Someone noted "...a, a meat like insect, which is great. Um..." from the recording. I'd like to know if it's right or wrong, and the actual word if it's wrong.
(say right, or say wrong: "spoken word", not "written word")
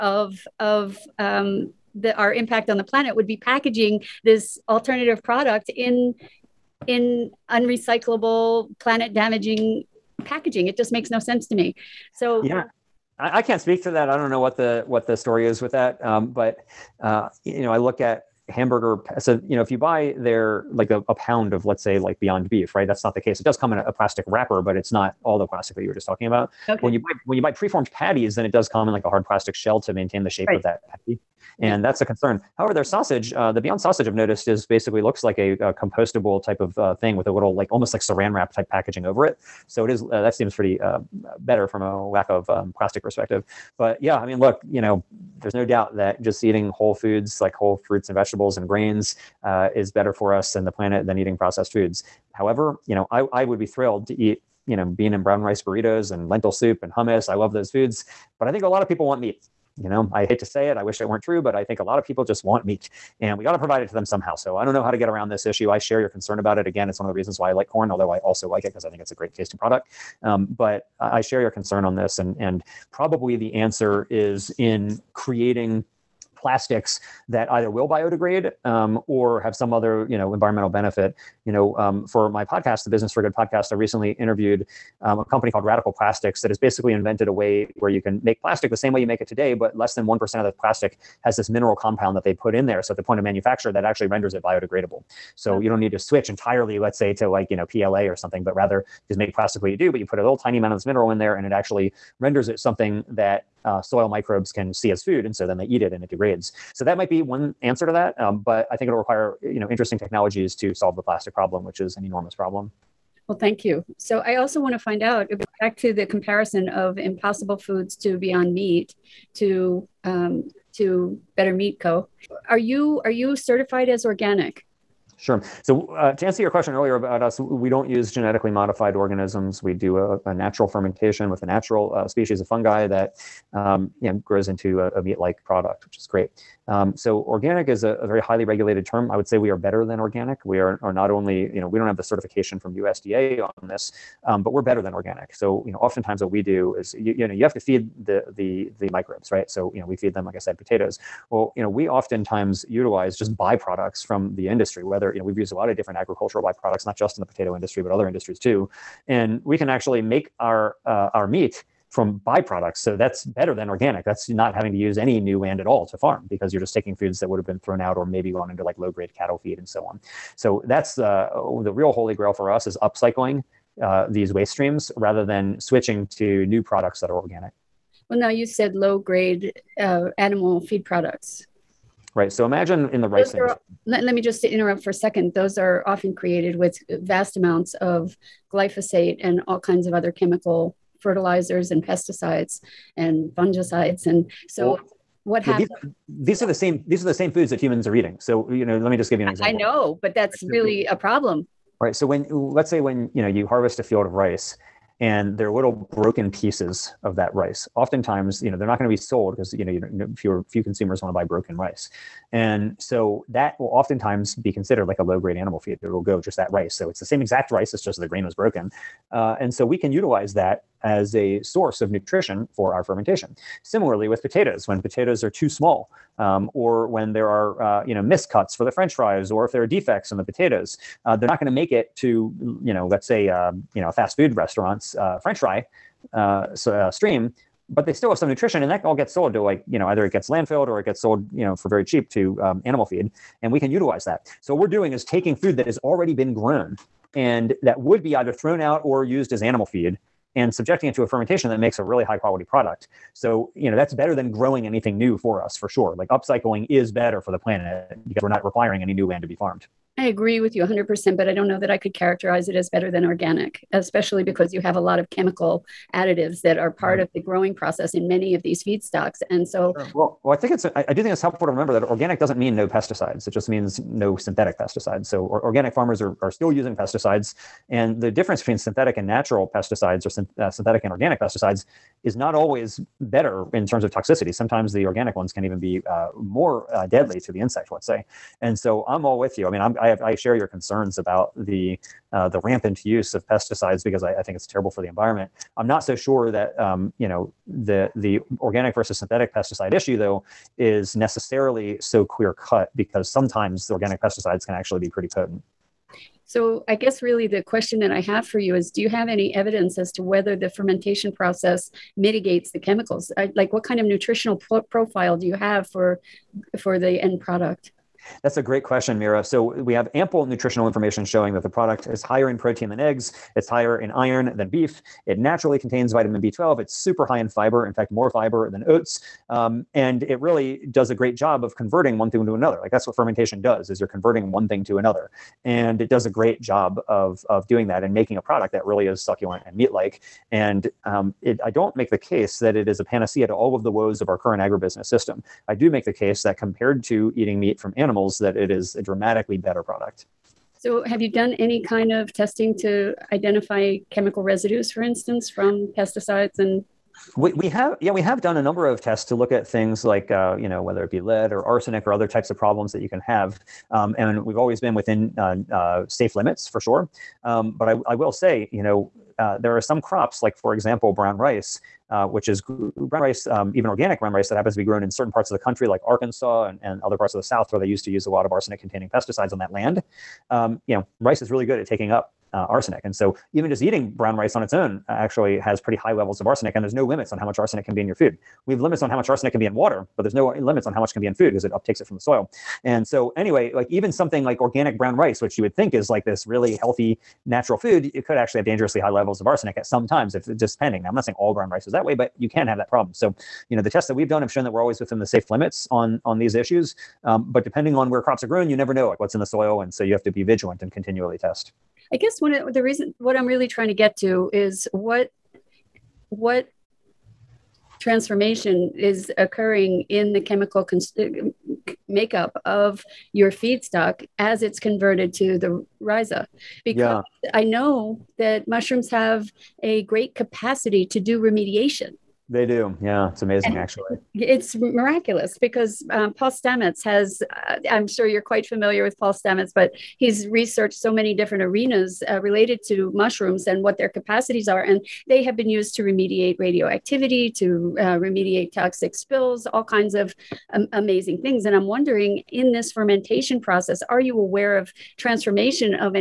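wrong: "product", not "insect".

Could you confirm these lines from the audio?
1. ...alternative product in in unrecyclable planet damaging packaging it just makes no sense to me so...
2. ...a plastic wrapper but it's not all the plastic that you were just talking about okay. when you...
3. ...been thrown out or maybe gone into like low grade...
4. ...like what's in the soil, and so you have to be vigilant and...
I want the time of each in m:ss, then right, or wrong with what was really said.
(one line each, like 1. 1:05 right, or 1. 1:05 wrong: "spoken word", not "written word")
1. 0:04 right
2. 0:23 right
3. 2:47 right
4. 6:48 right.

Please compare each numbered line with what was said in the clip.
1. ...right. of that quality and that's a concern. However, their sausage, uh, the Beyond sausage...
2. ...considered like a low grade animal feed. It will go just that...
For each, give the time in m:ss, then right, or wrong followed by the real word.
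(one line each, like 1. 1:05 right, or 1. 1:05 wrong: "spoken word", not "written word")
1. 0:30 wrong: "patty", not "quality"
2. 3:34 right.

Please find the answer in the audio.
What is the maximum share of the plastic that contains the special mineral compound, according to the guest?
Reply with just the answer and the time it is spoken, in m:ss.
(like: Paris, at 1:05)
less than 1%, at 1:29.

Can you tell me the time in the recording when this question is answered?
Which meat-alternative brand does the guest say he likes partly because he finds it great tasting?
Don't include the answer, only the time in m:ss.
1:07.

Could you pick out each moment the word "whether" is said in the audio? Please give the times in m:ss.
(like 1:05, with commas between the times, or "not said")
2:34, 5:10, 6:00.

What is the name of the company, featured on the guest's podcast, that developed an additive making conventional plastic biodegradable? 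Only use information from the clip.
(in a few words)
Radical Plastics.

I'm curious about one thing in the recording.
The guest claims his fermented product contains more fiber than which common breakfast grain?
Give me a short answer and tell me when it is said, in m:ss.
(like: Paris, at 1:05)
oats, at 5:28.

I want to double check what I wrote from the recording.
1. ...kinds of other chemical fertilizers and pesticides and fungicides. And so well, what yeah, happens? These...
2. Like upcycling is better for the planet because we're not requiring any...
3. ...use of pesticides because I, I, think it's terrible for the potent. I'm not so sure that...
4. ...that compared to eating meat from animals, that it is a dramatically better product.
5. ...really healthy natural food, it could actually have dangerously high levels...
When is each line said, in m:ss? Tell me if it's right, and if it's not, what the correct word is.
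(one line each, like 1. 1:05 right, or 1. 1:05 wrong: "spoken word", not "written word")
1. 3:09 right
2. 4:15 right
3. 4:52 wrong: "environment", not "potent"
4. 5:46 right
5. 6:36 right.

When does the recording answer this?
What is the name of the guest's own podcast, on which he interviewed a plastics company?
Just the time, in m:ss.
1:22.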